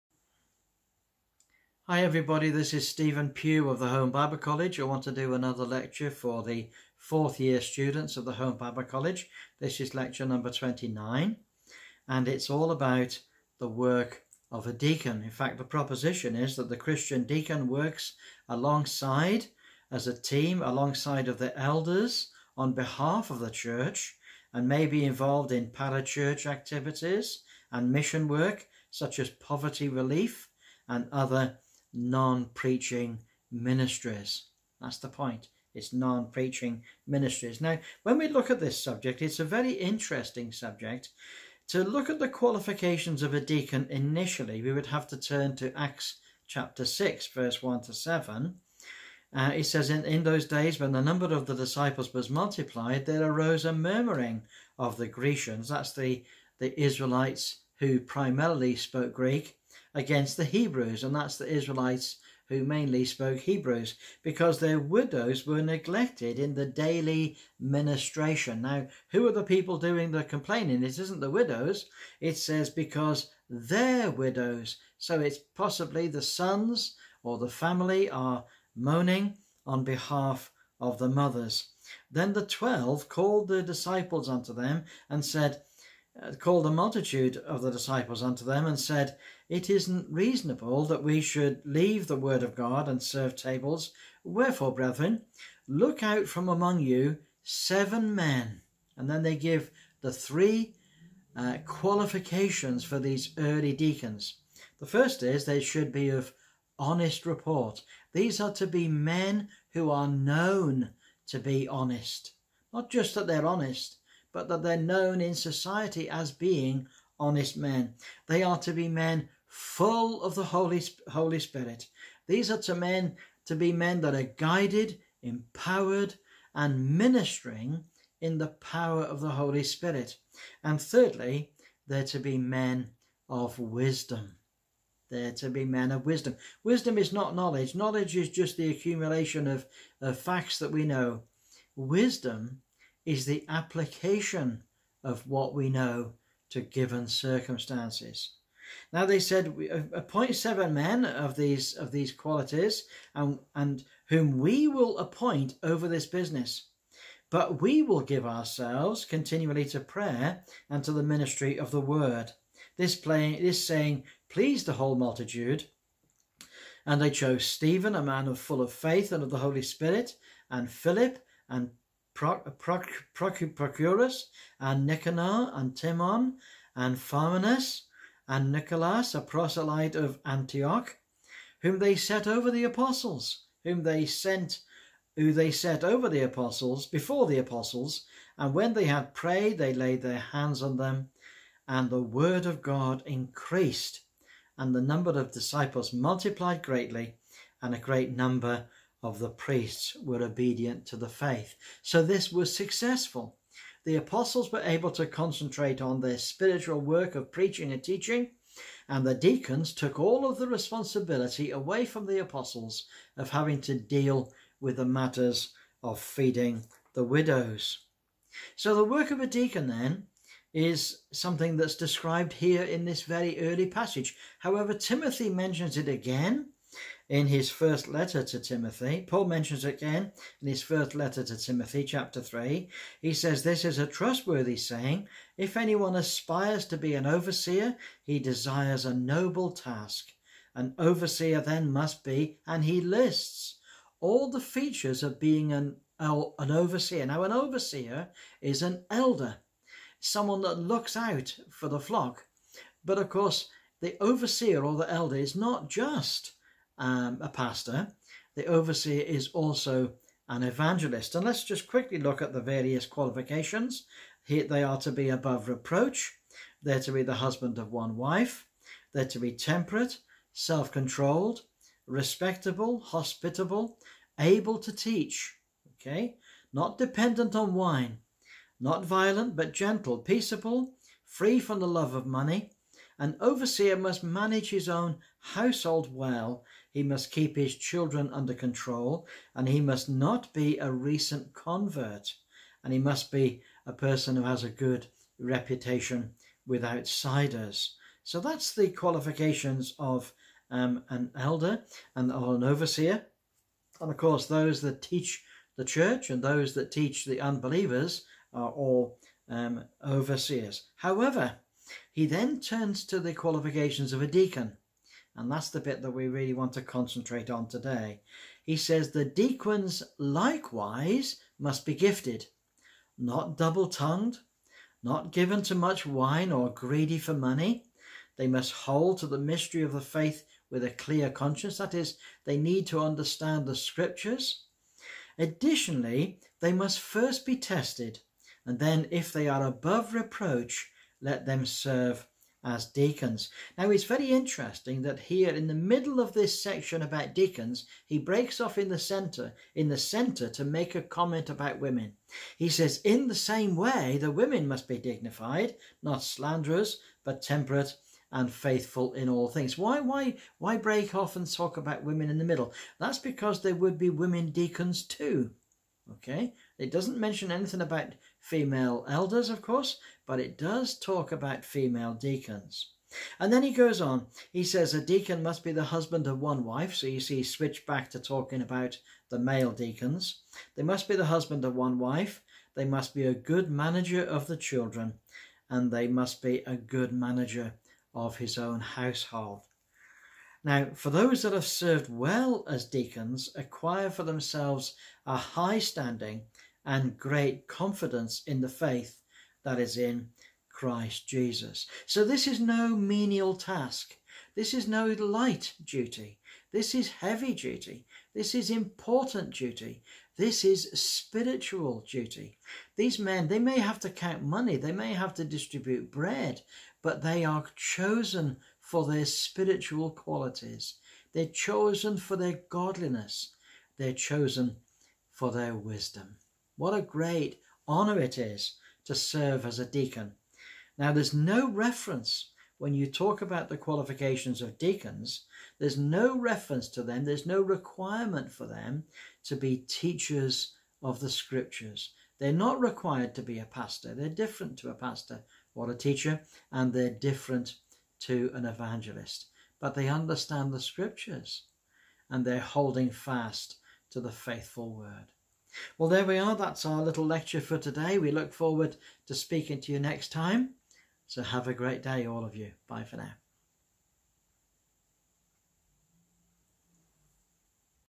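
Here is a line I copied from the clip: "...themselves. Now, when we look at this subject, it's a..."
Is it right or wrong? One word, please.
wrong.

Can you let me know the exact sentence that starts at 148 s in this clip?
Now they said, appoint seven men of these of these qualities, and and whom we will appoint over this business.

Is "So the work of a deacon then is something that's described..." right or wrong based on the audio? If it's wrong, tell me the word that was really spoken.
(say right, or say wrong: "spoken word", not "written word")
right.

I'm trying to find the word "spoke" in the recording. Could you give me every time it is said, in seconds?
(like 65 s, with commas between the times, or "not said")
58 s, 63 s.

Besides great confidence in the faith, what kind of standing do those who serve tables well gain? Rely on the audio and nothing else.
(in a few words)
High standing.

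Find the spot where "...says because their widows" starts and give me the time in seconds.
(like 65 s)
72 s.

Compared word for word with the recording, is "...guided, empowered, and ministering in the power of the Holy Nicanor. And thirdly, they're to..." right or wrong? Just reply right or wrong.
wrong.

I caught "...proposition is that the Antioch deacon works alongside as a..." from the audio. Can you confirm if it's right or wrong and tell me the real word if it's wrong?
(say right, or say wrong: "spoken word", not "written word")
wrong: "Christian", not "Antioch".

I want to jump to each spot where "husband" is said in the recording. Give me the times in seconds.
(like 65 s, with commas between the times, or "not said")
267 s, 375 s, 381 s.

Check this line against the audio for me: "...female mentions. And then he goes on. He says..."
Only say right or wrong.
wrong.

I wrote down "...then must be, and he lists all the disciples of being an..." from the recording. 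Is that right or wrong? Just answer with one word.
wrong.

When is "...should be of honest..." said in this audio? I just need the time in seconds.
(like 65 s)
105 s.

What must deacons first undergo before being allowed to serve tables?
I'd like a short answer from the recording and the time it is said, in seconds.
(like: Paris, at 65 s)
Be tested, at 337 s.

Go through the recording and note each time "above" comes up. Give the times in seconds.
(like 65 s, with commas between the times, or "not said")
265 s, 339 s.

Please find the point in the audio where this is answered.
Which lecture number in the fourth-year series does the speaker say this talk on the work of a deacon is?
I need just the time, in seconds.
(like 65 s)
9 s.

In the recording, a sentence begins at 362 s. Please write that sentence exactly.
That's because there would be women deacons too.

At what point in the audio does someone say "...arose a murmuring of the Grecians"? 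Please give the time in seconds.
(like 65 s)
53 s.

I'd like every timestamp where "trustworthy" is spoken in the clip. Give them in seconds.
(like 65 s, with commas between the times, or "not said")
233 s.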